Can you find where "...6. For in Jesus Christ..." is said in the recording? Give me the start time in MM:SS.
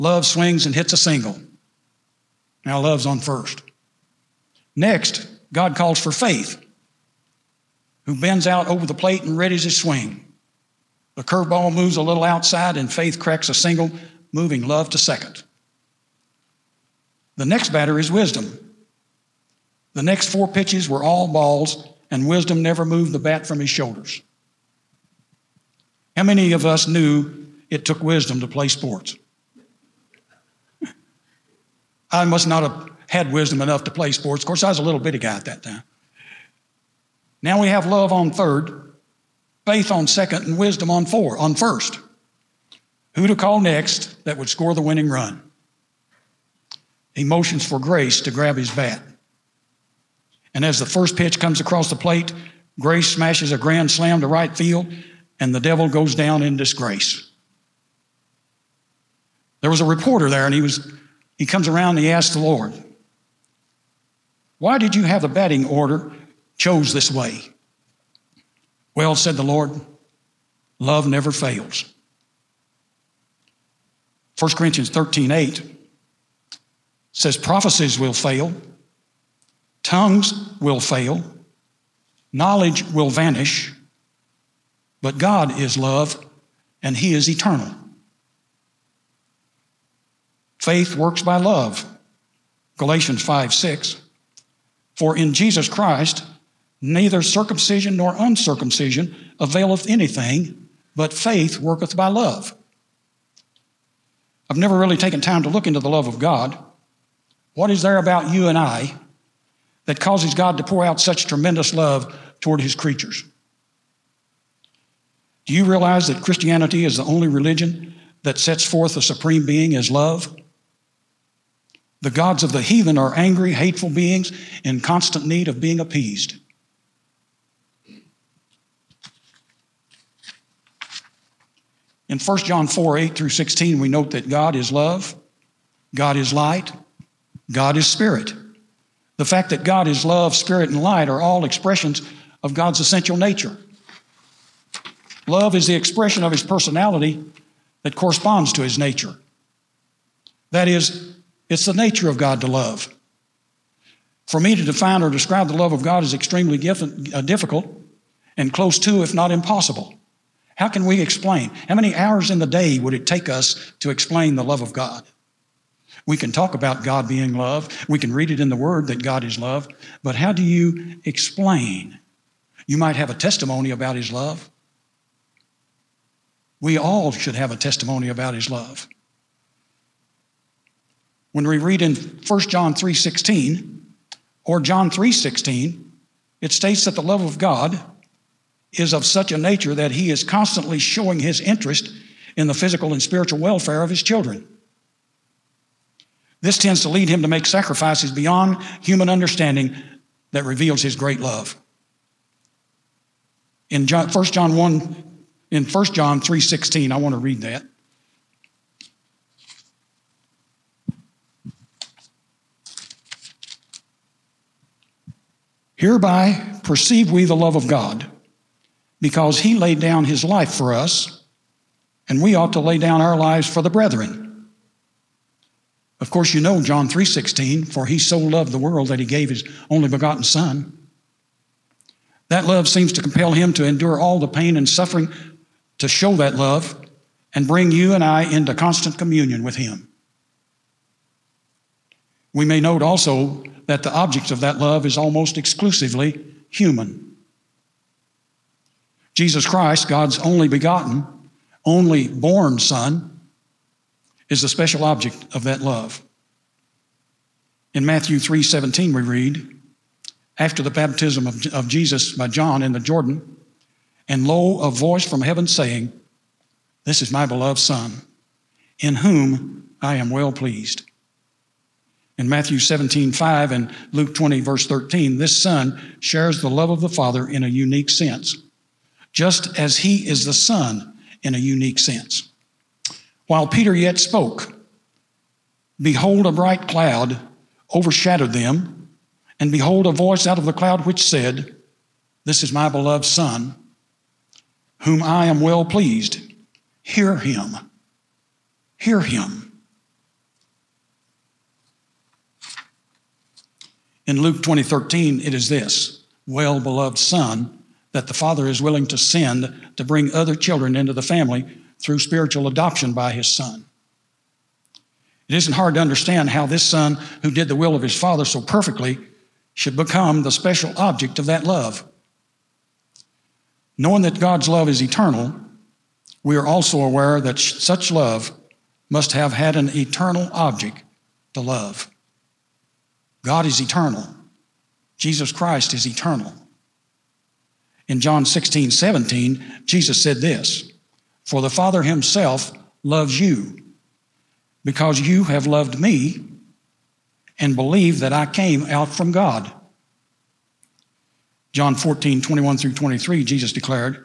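01:33.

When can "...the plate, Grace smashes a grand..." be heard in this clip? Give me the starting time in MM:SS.
00:51.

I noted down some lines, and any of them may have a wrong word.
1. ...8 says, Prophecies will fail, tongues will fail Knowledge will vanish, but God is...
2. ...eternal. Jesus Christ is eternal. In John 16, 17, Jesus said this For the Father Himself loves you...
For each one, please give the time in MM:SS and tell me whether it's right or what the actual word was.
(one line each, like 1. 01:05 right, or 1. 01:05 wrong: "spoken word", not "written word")
1. 01:15 right
2. 05:33 right.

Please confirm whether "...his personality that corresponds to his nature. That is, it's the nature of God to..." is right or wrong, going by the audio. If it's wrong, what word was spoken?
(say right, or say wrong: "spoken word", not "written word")
right.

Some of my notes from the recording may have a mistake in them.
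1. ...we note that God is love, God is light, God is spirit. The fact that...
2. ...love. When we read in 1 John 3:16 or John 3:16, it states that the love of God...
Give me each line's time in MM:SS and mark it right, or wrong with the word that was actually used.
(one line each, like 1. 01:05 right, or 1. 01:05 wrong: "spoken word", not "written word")
1. 02:13 right
2. 02:58 right.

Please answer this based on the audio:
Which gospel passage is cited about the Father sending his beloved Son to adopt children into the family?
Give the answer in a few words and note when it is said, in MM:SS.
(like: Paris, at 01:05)
Luke 20:13, at 05:04.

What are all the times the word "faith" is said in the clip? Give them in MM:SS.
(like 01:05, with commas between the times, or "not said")
00:06, 00:12, 00:39, 01:30, 01:41.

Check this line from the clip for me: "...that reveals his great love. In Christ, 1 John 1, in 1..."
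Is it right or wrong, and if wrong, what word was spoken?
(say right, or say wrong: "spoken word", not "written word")
wrong: "John", not "Christ".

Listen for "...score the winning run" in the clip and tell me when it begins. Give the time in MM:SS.
00:44.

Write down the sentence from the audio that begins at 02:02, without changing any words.
The gods of the heathen are angry, hateful beings in constant need of being appeased.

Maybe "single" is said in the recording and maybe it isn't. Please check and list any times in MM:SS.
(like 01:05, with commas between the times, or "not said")
00:00, 00:13.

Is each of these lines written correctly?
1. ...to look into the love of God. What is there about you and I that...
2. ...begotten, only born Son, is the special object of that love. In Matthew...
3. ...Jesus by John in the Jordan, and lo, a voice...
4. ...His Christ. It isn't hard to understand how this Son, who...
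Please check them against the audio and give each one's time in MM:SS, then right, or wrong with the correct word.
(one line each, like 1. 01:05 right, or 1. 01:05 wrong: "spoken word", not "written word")
1. 01:45 right
2. 04:10 right
3. 04:21 right
4. 05:13 wrong: "Son", not "Christ".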